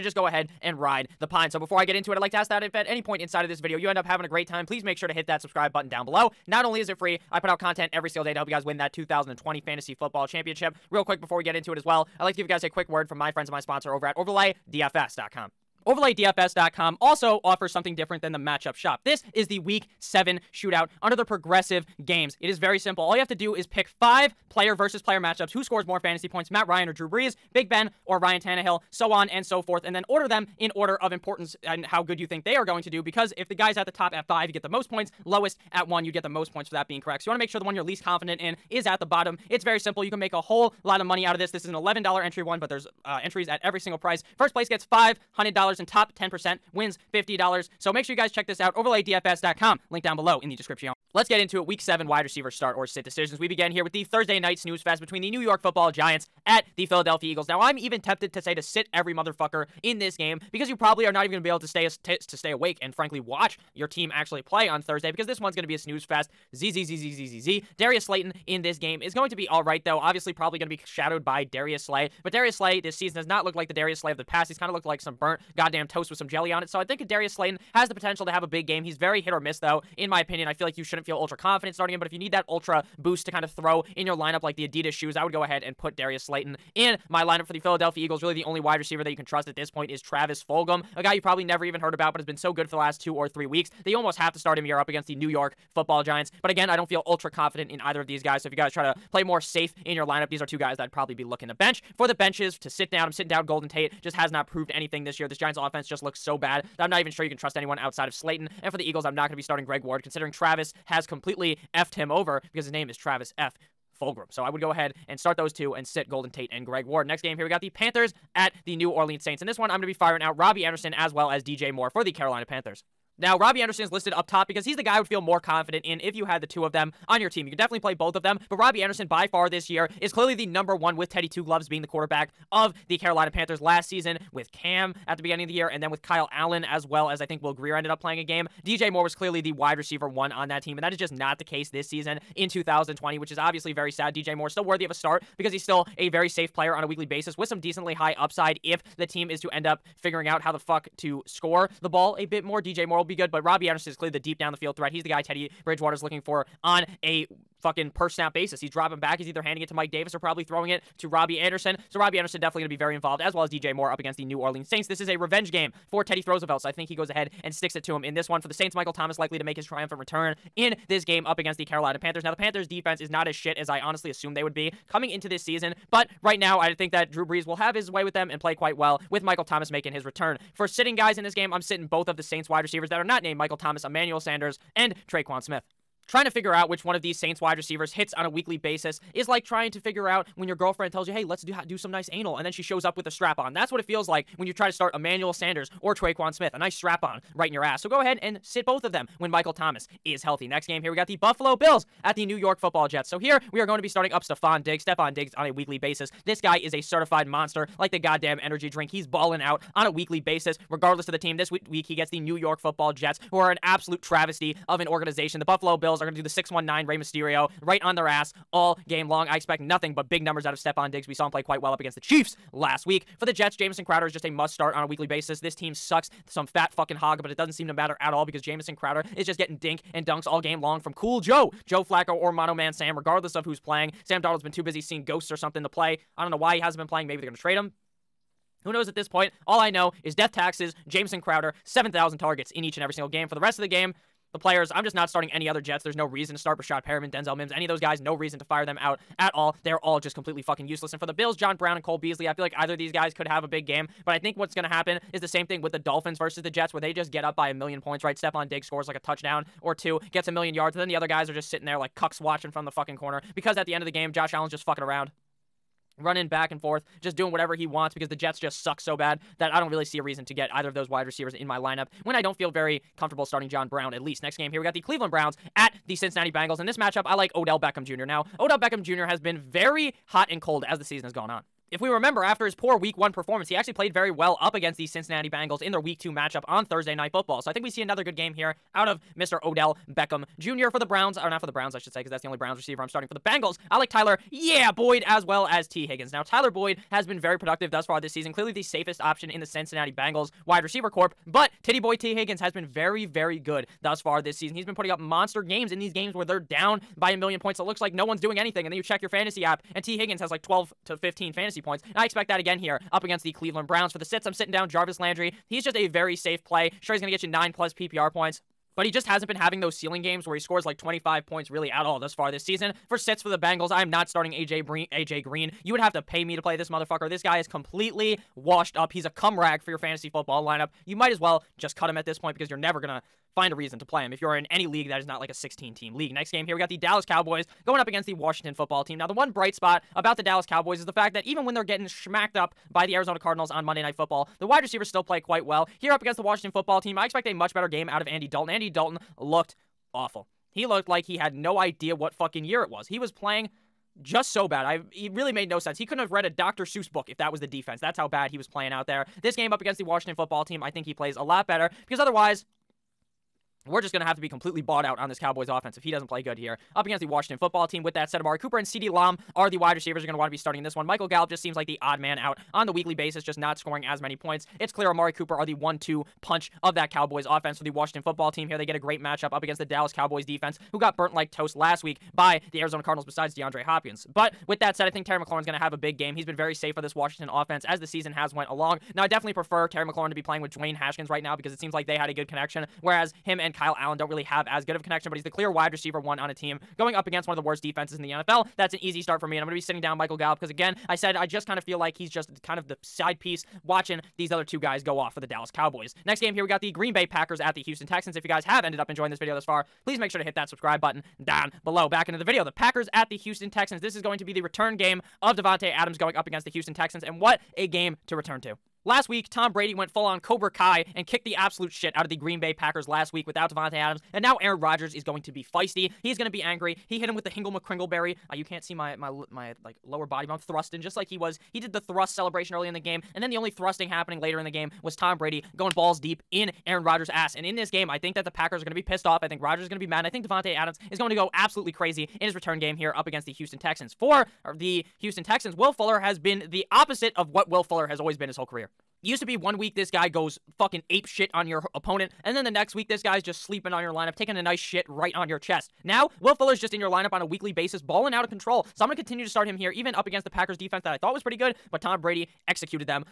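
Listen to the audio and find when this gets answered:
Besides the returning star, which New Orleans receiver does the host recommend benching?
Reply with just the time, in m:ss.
3:03.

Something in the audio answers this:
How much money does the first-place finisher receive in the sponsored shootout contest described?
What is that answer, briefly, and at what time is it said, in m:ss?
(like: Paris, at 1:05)
$500, at 0:44.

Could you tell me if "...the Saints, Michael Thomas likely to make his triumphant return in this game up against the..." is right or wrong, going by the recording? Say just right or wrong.
right.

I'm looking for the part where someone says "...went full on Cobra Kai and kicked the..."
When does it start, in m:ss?
6:59.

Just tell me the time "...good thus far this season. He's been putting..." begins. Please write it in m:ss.
5:03.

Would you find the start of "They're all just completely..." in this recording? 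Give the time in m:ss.
4:09.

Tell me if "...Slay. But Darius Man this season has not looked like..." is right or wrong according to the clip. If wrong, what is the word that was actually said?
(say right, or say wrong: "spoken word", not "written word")
wrong: "Slay", not "Man".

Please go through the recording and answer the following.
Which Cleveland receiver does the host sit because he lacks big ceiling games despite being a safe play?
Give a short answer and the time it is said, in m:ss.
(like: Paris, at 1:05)
Jarvis Landry, at 5:14.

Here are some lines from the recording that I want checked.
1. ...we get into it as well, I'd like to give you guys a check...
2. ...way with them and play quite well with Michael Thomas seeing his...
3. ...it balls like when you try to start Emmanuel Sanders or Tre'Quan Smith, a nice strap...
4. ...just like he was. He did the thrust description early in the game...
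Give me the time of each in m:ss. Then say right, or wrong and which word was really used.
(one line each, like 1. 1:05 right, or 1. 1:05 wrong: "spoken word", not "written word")
1. 0:11 wrong: "quick", not "check"
2. 2:57 wrong: "making", not "seeing"
3. 3:13 wrong: "feels", not "balls"
4. 7:10 wrong: "celebration", not "description".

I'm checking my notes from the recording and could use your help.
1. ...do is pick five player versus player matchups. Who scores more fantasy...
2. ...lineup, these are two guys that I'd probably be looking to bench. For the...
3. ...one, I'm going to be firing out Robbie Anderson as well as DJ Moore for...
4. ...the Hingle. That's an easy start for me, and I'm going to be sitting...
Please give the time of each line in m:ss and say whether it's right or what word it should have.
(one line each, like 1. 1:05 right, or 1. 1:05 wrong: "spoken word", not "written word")
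1. 0:23 right
2. 1:40 right
3. 1:59 right
4. 6:38 wrong: "NFL", not "Hingle".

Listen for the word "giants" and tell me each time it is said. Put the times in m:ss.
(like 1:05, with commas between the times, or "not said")
0:55, 1:36, 1:45.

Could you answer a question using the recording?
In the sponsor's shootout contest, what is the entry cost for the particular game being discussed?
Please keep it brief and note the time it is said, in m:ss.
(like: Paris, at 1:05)
$11, at 0:41.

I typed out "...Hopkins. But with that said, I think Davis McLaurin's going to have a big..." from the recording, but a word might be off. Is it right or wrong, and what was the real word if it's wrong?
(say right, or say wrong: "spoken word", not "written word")
wrong: "Terry", not "Davis".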